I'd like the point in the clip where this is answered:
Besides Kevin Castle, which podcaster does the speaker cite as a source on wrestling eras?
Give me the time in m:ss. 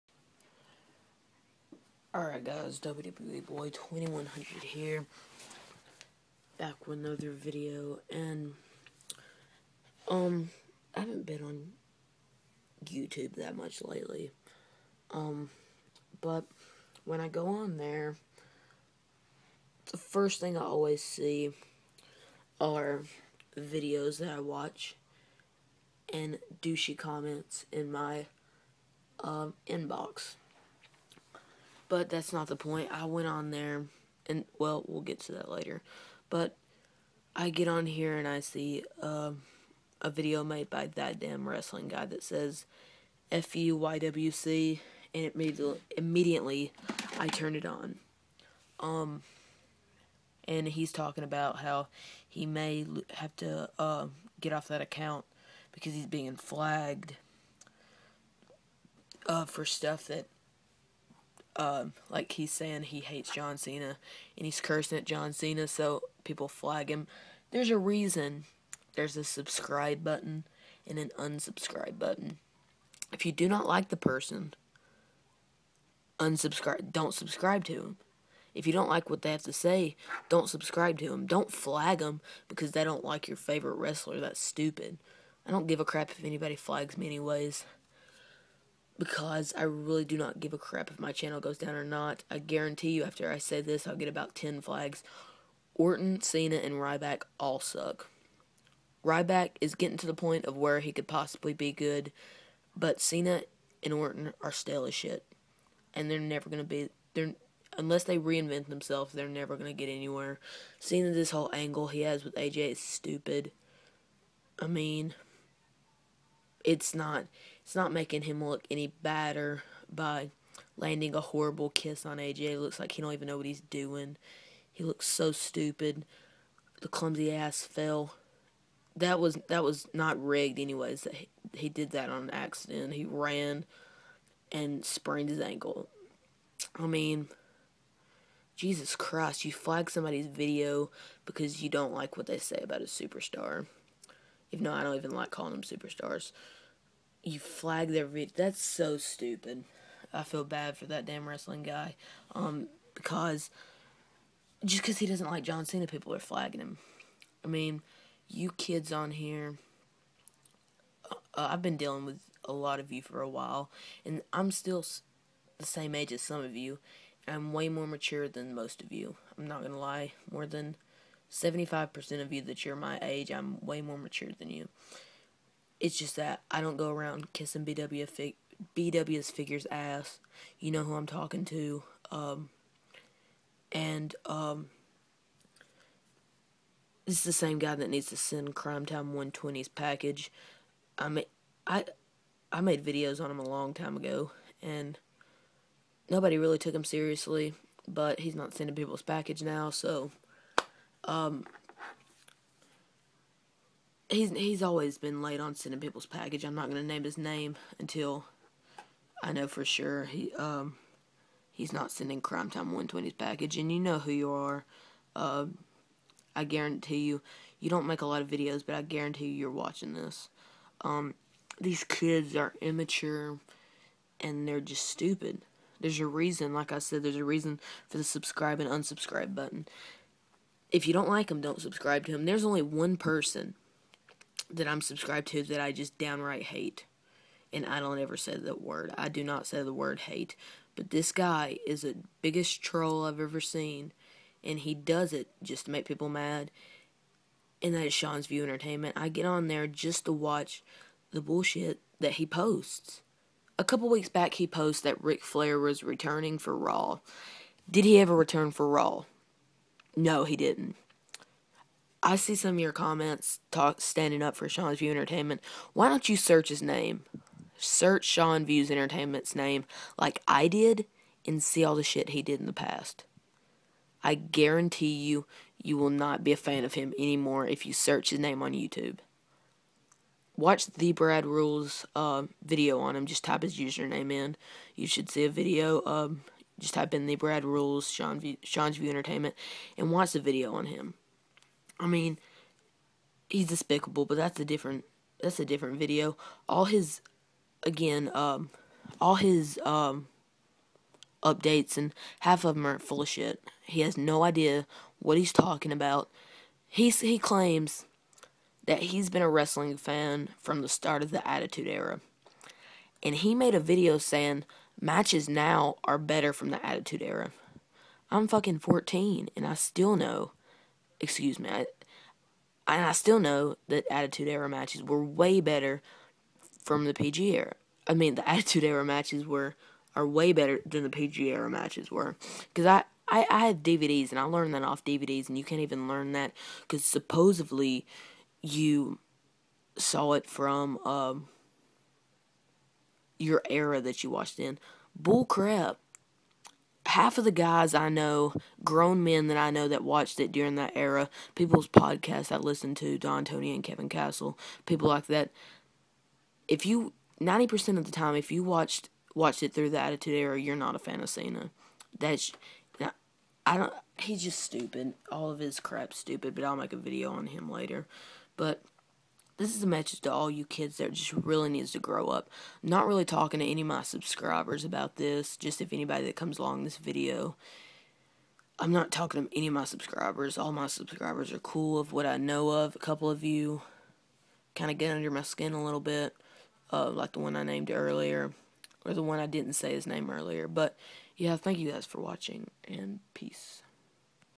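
5:52.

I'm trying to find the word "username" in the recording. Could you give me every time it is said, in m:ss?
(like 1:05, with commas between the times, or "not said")
4:43.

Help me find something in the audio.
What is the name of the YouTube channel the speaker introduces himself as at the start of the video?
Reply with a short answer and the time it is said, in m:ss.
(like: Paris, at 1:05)
WWE Boy 2100, at 0:02.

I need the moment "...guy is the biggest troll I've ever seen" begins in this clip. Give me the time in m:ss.
4:01.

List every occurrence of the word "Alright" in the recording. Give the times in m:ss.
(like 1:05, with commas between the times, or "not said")
0:02.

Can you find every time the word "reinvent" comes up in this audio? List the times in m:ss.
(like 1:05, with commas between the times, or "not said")
1:48.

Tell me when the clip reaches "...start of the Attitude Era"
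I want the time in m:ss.
5:10.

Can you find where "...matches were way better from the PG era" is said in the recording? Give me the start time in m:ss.
5:24.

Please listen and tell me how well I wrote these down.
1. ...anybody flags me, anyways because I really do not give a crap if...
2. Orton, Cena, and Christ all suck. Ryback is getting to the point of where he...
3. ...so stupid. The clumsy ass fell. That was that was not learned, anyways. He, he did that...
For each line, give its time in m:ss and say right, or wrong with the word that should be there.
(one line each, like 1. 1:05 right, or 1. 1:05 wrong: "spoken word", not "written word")
1. 1:26 right
2. 1:35 wrong: "Ryback", not "Christ"
3. 2:05 wrong: "rigged", not "learned".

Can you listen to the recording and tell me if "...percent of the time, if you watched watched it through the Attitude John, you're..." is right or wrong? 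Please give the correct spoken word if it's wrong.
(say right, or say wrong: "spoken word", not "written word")
wrong: "Era", not "John".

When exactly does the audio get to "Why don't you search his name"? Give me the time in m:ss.
4:25.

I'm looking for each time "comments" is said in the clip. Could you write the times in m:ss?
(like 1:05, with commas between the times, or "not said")
0:26, 4:22.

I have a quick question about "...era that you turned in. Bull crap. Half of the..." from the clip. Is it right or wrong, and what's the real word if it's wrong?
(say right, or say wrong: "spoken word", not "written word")
wrong: "watched", not "turned".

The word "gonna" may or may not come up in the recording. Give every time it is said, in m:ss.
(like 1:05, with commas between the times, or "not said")
2:49, 3:26.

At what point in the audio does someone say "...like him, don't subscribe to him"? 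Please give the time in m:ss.
3:51.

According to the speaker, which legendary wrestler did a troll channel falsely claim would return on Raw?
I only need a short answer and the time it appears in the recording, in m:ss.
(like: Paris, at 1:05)
Ric Flair, at 4:15.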